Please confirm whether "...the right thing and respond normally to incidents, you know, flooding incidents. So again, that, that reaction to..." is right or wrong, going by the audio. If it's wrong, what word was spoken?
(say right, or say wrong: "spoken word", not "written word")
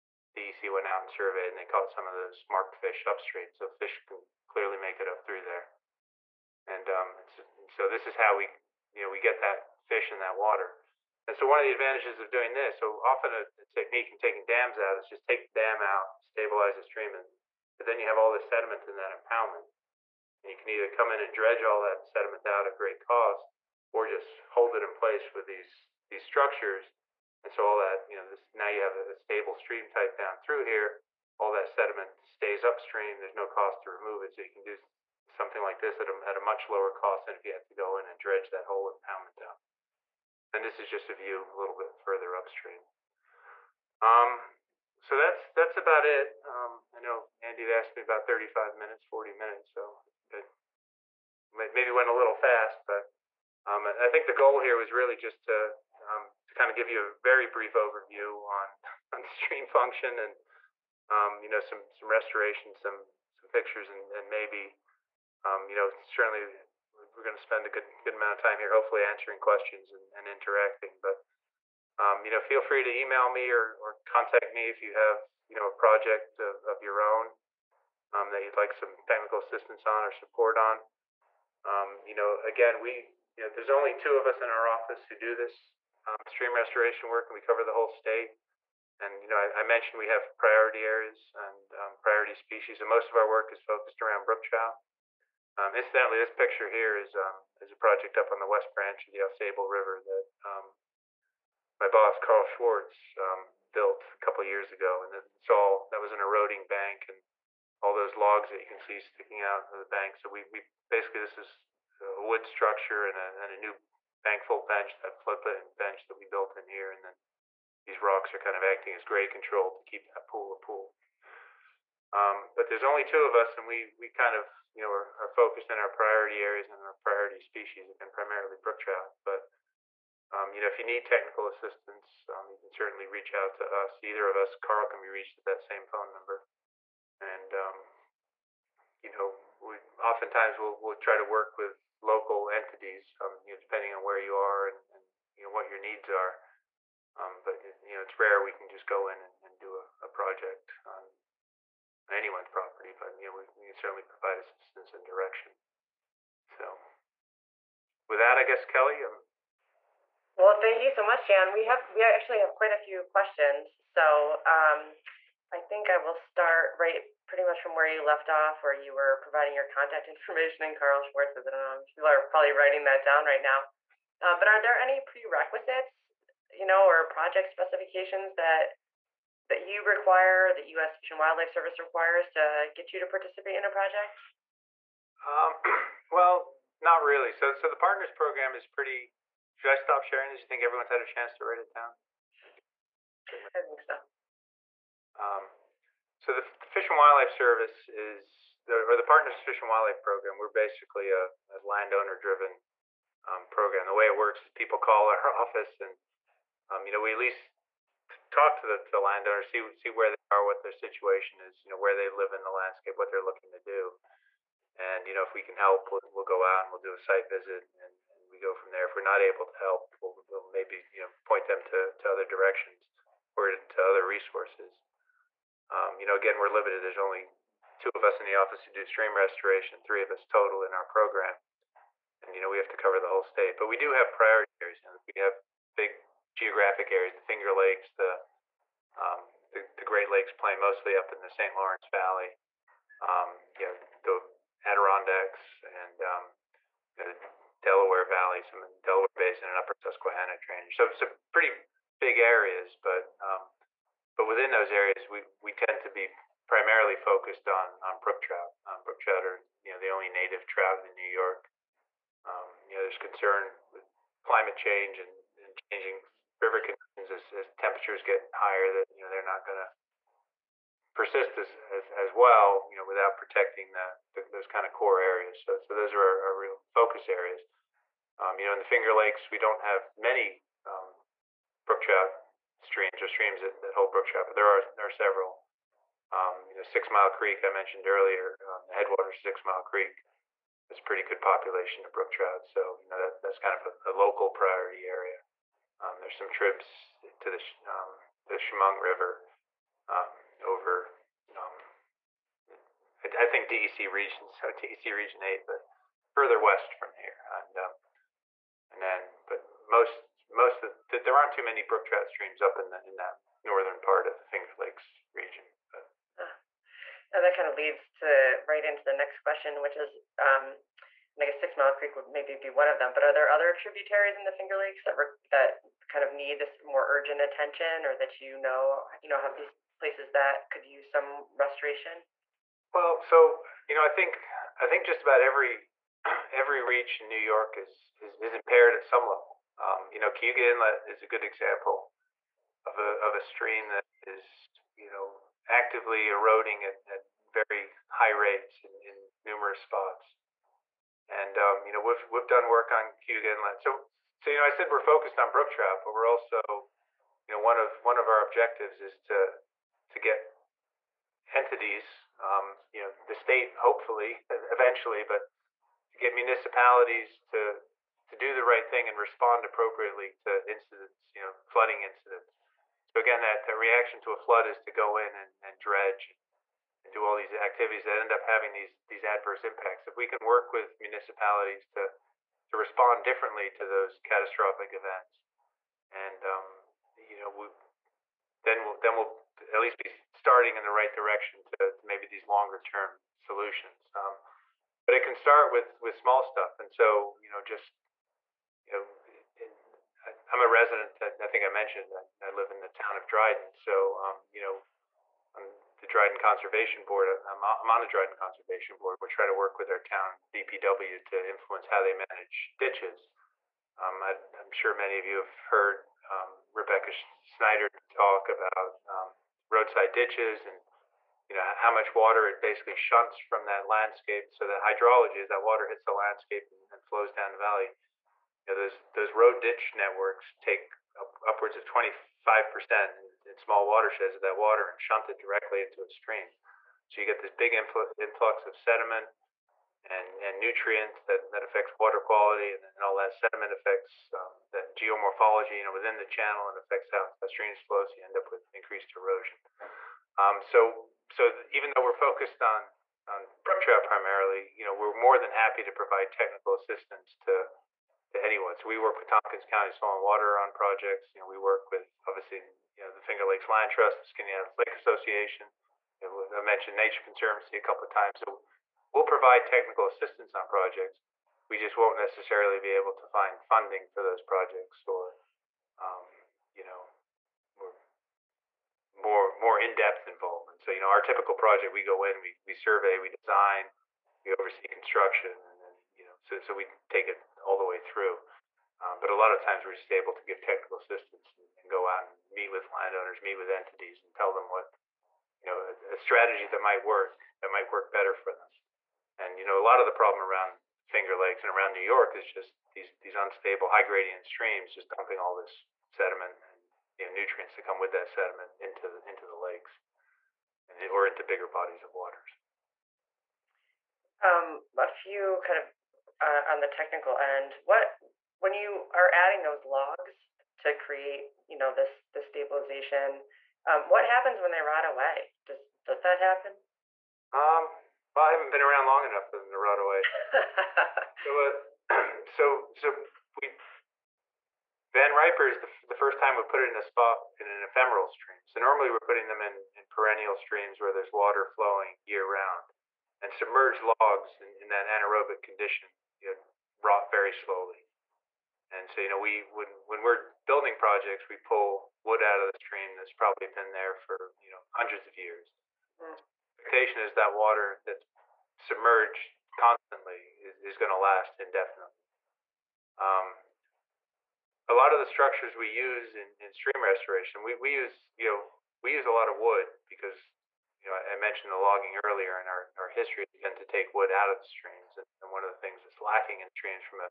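wrong: "appropriately", not "normally".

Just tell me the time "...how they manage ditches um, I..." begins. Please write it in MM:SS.
06:51.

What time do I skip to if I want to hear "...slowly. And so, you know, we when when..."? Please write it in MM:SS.
09:07.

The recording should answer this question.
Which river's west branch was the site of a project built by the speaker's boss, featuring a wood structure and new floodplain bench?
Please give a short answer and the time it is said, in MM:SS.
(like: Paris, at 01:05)
Ausable River, at 01:39.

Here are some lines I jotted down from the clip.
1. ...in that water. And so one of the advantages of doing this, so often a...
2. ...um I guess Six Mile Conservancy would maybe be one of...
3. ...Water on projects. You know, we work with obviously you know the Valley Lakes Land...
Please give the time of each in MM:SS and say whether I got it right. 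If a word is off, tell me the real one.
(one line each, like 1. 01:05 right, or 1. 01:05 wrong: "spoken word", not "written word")
1. 00:10 right
2. 05:20 wrong: "Creek", not "Conservancy"
3. 07:40 wrong: "Finger", not "Valley".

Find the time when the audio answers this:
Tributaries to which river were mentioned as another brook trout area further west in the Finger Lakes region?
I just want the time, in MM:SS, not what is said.
04:58.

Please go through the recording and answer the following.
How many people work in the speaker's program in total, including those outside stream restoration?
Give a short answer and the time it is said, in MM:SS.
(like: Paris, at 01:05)
3, at 03:49.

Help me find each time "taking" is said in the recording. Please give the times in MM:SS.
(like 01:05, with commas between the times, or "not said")
00:14.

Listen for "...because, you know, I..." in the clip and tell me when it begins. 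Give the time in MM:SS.
09:29.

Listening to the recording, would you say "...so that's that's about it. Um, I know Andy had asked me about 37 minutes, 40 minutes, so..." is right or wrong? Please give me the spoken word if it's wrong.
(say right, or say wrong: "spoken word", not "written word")
wrong: "35", not "37".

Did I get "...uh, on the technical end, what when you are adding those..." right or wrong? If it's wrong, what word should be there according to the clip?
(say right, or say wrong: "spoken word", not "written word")
right.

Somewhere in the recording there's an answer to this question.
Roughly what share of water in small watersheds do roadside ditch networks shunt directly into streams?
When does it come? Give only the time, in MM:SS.
07:11.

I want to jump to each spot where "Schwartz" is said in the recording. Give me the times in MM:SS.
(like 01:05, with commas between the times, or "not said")
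01:42, 02:51.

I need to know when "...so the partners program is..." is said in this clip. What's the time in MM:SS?
03:07.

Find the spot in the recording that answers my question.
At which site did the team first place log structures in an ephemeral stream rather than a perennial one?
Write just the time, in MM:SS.
08:54.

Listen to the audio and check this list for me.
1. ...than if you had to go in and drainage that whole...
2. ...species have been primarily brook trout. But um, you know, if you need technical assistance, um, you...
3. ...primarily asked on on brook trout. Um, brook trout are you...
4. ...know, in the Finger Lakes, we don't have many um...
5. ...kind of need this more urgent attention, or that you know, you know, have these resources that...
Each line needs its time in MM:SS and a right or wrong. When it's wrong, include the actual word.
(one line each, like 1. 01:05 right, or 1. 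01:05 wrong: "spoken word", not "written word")
1. 00:37 wrong: "dredge", not "drainage"
2. 02:07 right
3. 04:16 wrong: "focused", not "asked"
4. 04:38 right
5. 05:25 wrong: "places", not "resources".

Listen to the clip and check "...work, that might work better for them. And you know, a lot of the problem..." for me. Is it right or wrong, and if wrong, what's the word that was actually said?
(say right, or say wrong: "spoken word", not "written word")
right.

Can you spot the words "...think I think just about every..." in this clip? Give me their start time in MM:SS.
05:33.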